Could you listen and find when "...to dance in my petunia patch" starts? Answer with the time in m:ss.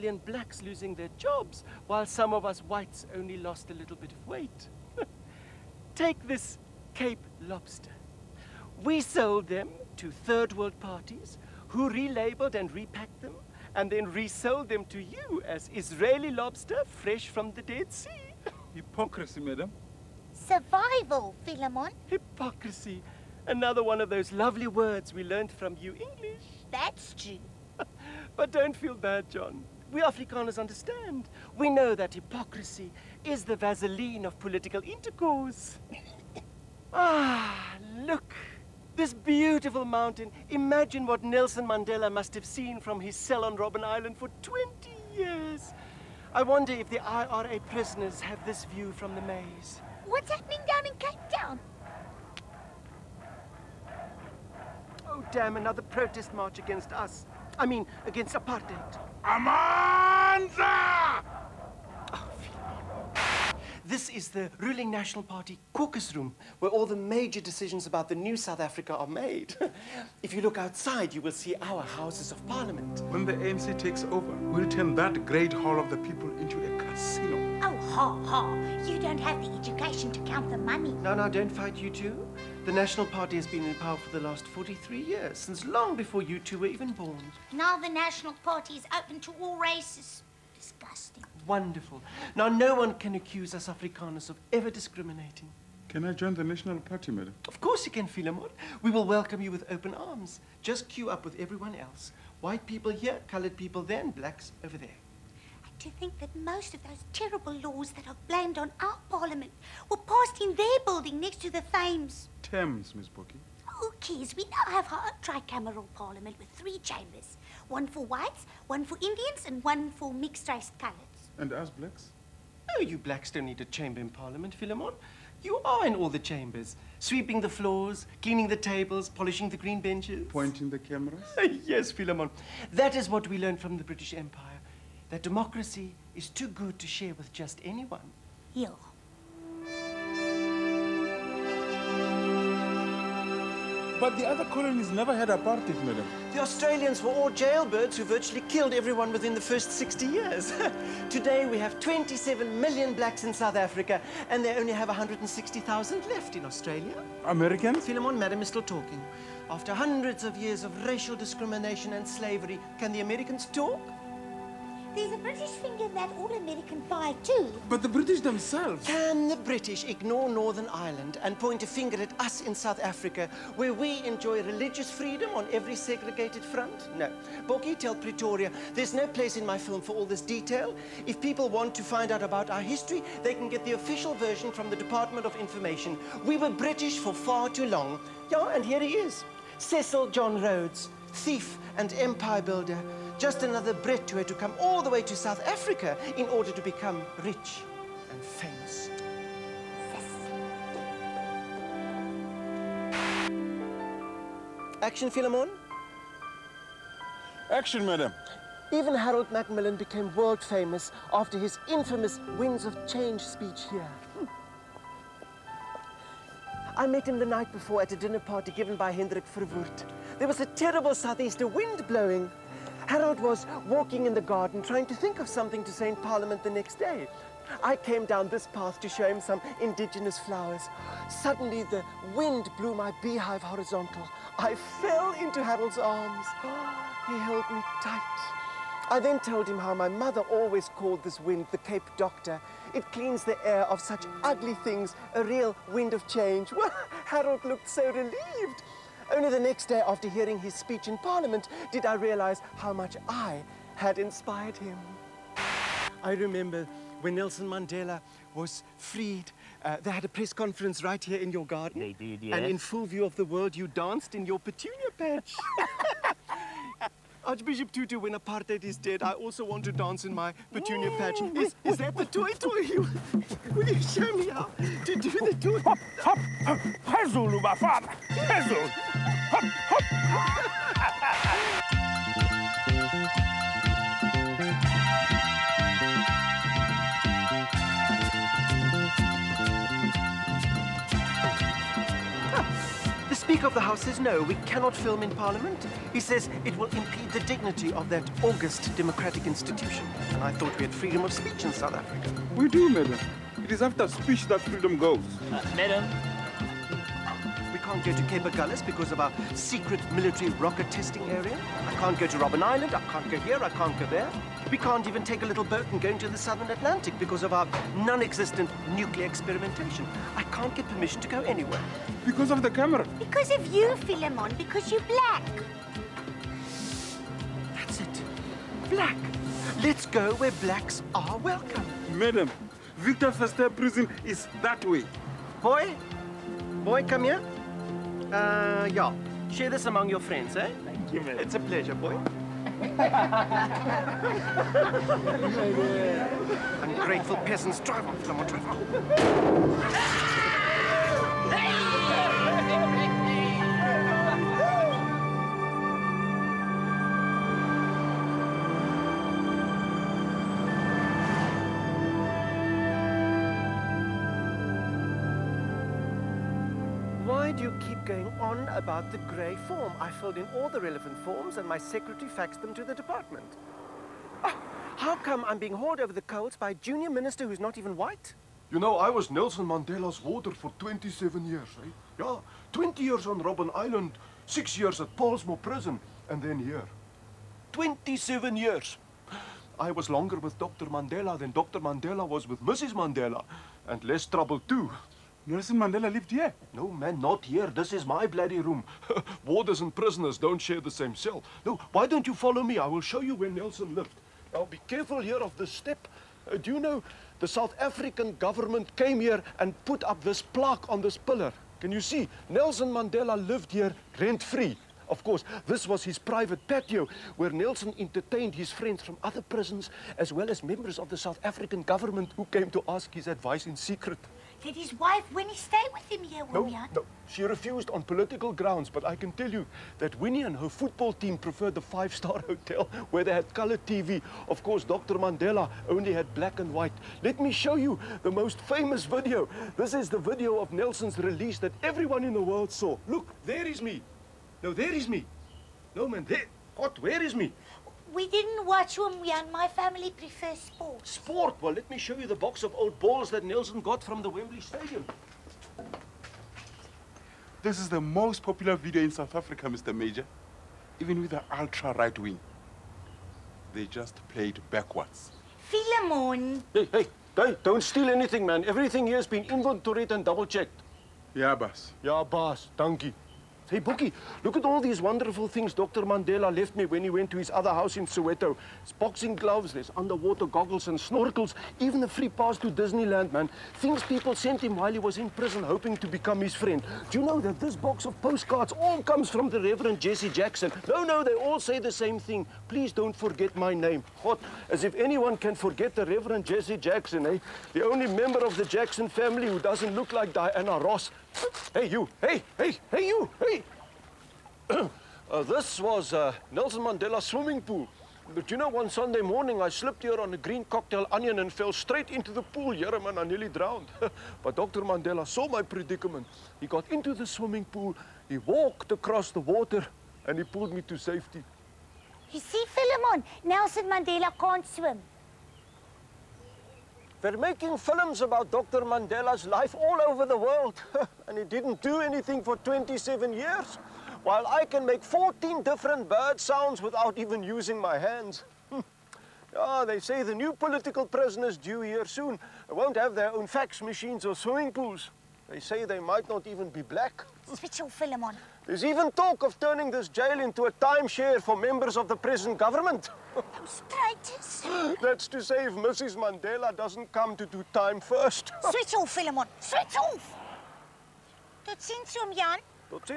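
4:29.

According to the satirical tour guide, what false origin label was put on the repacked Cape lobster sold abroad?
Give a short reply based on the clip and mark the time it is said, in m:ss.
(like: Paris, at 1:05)
Israeli lobster, at 0:15.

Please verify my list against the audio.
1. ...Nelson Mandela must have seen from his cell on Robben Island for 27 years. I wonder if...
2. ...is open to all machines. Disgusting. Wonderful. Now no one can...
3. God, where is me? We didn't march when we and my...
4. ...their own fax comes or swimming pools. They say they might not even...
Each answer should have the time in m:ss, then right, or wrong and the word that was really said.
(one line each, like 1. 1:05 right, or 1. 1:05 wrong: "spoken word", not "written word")
1. 0:41 wrong: "20", not "27"
2. 1:28 wrong: "races", not "machines"
3. 7:26 wrong: "watch", not "march"
4. 9:02 wrong: "machines", not "comes".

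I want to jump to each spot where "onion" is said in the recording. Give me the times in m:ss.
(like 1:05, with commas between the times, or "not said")
8:30.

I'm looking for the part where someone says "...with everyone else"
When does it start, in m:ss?
1:41.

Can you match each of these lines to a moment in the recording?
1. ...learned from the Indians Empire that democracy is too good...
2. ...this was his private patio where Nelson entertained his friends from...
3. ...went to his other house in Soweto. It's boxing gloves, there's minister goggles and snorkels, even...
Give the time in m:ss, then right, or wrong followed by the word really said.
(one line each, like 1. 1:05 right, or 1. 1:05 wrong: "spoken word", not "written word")
1. 2:13 wrong: "British", not "Indians"
2. 6:55 right
3. 7:56 wrong: "underwater", not "minister".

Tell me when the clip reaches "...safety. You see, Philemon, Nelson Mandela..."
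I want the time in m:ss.
8:40.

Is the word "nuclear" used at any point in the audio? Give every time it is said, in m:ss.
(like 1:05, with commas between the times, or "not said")
5:18.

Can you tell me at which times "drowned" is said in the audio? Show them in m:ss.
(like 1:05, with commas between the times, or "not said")
8:33.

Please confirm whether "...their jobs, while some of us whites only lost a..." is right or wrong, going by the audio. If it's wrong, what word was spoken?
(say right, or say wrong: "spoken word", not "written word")
right.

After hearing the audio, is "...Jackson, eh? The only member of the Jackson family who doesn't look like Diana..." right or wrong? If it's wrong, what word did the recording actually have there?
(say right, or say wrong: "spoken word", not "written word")
right.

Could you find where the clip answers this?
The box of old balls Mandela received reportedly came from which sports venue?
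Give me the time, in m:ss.
7:34.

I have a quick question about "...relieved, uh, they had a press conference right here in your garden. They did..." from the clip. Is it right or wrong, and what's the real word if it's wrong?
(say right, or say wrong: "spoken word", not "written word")
wrong: "freed", not "relieved".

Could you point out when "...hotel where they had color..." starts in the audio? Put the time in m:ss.
7:12.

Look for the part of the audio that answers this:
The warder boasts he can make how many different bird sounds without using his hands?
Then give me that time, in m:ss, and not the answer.
8:54.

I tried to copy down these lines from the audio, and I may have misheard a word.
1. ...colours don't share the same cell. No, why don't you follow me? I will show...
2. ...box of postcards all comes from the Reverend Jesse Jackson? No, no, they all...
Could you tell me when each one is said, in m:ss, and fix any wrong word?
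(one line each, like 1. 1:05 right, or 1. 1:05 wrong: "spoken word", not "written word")
1. 6:39 wrong: "prisoners", not "colours"
2. 8:07 right.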